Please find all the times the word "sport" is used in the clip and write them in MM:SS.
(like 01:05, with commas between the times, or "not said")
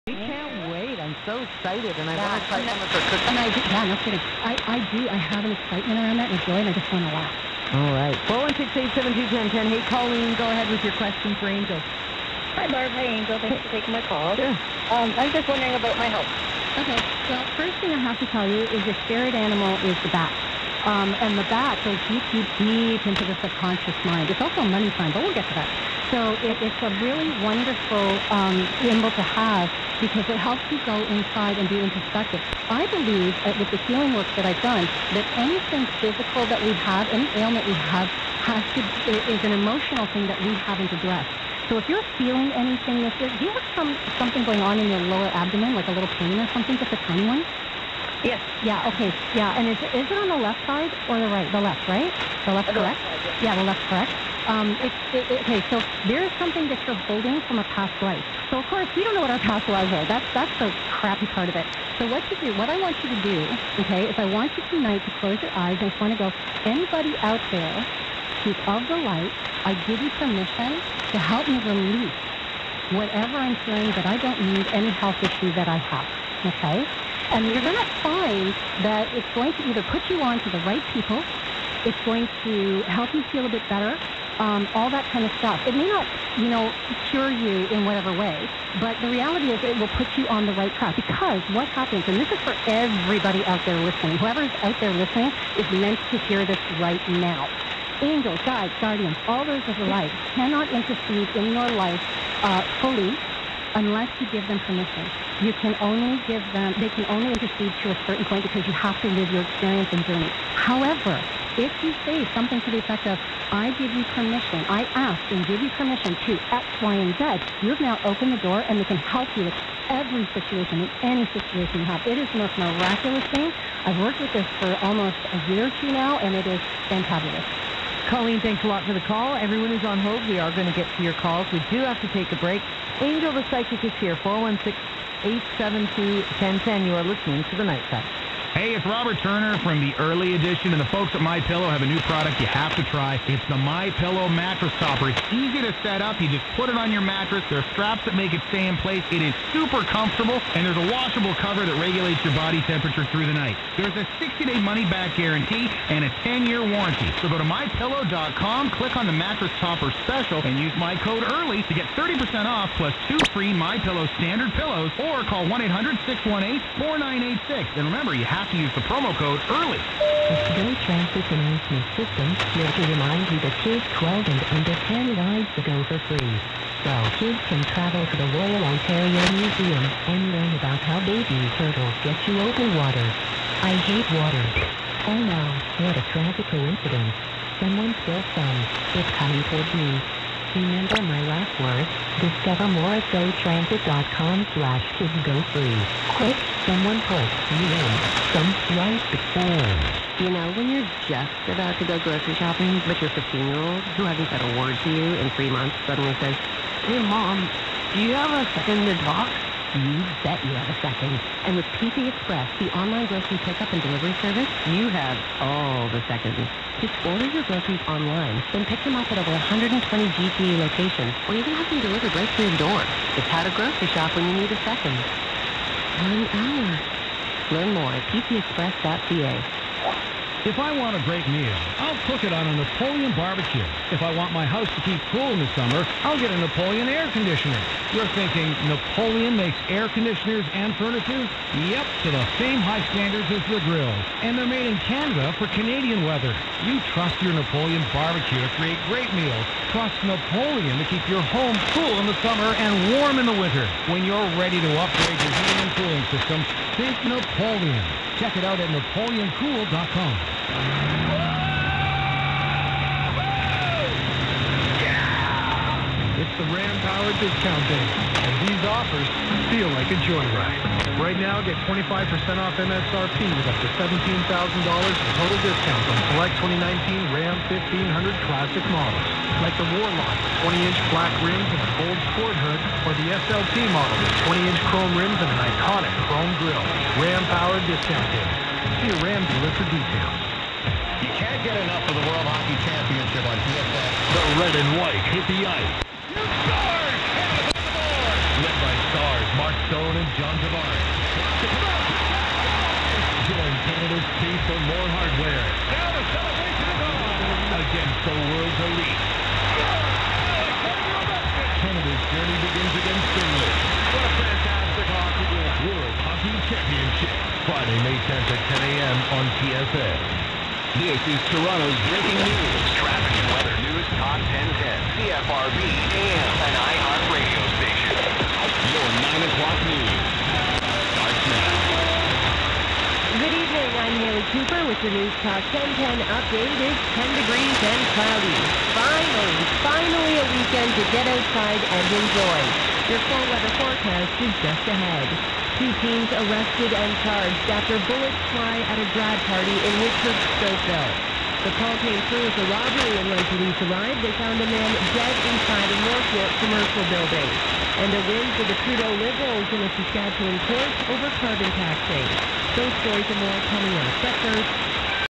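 04:42.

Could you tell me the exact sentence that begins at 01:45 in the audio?
You can only give them, they can only intercede to a certain point because you have to live your experience and journey.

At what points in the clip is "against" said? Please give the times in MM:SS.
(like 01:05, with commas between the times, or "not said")
05:07, 05:12.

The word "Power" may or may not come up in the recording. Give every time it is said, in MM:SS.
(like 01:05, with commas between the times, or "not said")
04:26, 04:47.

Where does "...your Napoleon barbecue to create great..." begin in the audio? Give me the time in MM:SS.
04:07.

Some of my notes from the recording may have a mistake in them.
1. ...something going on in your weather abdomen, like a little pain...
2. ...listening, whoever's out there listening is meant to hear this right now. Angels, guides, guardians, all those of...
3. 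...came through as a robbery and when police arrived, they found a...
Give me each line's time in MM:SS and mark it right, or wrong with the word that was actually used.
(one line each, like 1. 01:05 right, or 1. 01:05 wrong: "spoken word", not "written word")
1. 00:44 wrong: "lower", not "weather"
2. 01:33 right
3. 05:51 right.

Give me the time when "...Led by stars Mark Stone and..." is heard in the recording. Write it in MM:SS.
04:58.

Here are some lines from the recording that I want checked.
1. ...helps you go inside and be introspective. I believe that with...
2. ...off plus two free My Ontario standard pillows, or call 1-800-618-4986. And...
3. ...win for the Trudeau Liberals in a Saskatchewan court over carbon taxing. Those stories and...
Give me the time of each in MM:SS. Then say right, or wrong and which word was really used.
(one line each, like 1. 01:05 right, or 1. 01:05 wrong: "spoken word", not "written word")
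1. 00:30 right
2. 02:42 wrong: "Pillow", not "Ontario"
3. 05:58 right.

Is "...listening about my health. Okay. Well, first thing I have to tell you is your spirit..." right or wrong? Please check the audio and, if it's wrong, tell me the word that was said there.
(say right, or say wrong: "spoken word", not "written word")
wrong: "wondering", not "listening".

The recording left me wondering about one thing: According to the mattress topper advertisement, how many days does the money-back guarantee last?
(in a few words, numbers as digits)
60.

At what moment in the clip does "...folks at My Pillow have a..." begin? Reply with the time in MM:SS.
02:20.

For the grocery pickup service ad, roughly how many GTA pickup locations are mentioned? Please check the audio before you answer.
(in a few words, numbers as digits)
over 120.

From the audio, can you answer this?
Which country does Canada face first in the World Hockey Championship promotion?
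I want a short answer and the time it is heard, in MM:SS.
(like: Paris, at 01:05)
Finland, at 05:13.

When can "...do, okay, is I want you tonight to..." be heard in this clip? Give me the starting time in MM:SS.
01:03.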